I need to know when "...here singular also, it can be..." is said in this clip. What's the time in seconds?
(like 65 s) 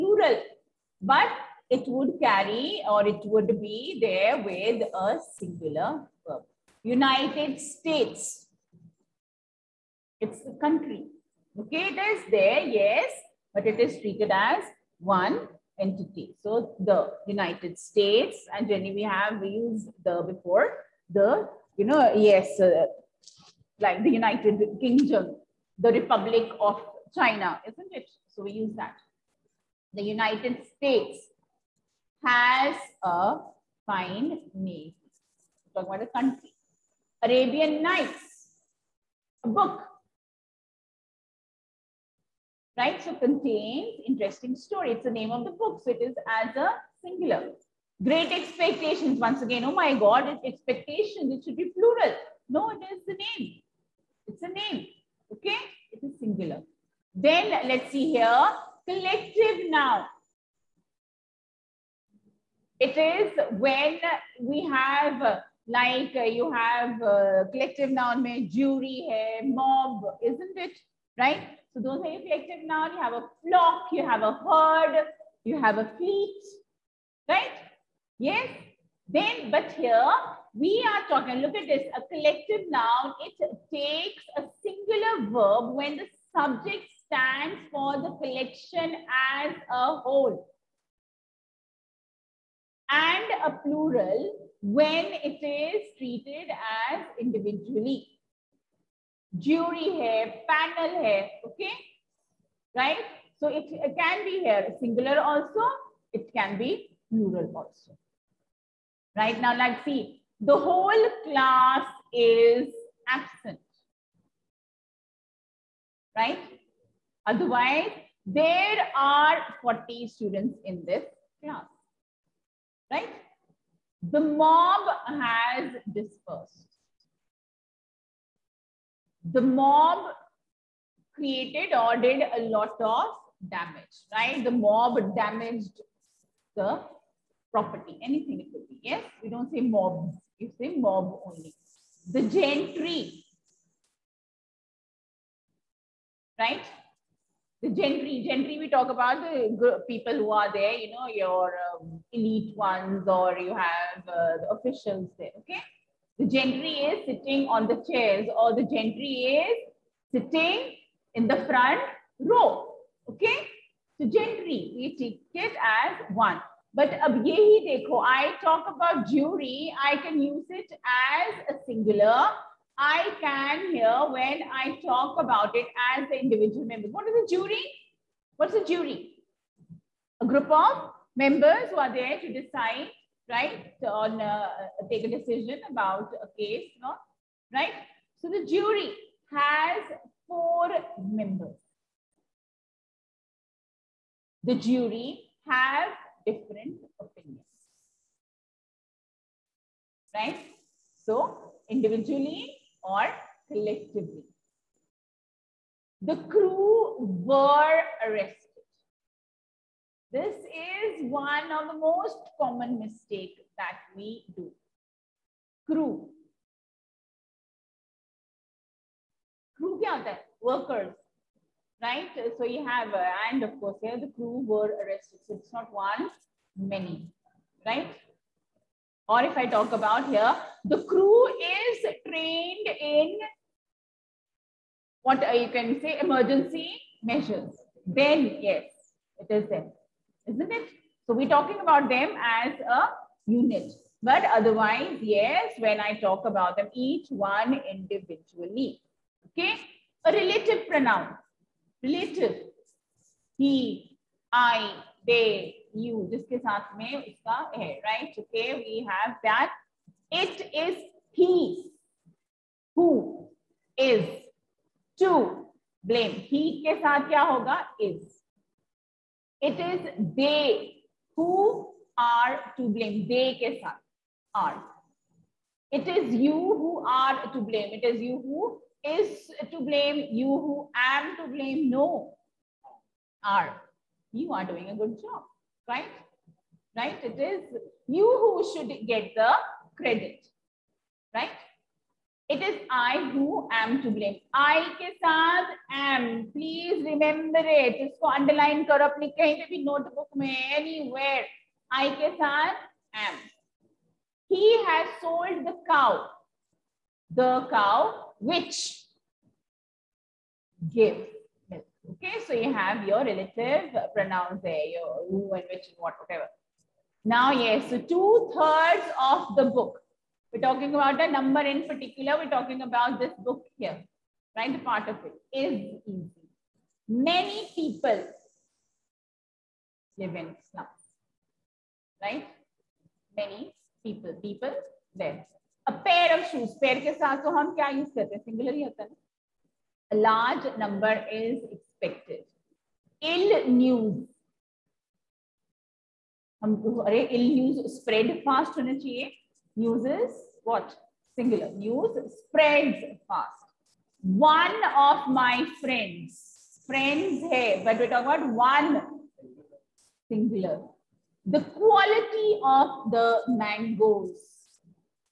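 104 s.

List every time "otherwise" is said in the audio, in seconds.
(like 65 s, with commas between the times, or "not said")
117 s, 244 s.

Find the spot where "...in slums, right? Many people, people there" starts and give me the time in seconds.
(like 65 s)
330 s.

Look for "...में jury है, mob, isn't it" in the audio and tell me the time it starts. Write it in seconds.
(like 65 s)
68 s.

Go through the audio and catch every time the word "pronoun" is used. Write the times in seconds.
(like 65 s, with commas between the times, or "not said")
250 s, 313 s.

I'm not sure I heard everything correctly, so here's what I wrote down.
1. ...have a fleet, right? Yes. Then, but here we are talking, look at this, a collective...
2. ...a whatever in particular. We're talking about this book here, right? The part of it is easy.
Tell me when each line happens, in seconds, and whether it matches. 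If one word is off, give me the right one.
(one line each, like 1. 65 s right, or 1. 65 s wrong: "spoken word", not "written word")
1. 75 s right
2. 321 s wrong: "number", not "whatever".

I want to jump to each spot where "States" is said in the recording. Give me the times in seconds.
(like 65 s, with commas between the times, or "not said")
7 s, 17 s, 30 s.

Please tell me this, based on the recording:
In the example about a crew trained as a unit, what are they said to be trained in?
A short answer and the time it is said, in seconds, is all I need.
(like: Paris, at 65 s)
emergency measures, at 235 s.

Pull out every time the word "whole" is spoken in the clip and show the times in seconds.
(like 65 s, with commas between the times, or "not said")
89 s, 110 s.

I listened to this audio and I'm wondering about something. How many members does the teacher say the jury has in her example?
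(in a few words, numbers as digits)
4.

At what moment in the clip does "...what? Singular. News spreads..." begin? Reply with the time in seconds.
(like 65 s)
350 s.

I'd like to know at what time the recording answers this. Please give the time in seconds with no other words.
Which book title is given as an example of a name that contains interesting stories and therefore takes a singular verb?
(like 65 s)
37 s.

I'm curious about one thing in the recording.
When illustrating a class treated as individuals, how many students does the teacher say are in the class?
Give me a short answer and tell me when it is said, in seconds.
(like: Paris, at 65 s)
40, at 119 s.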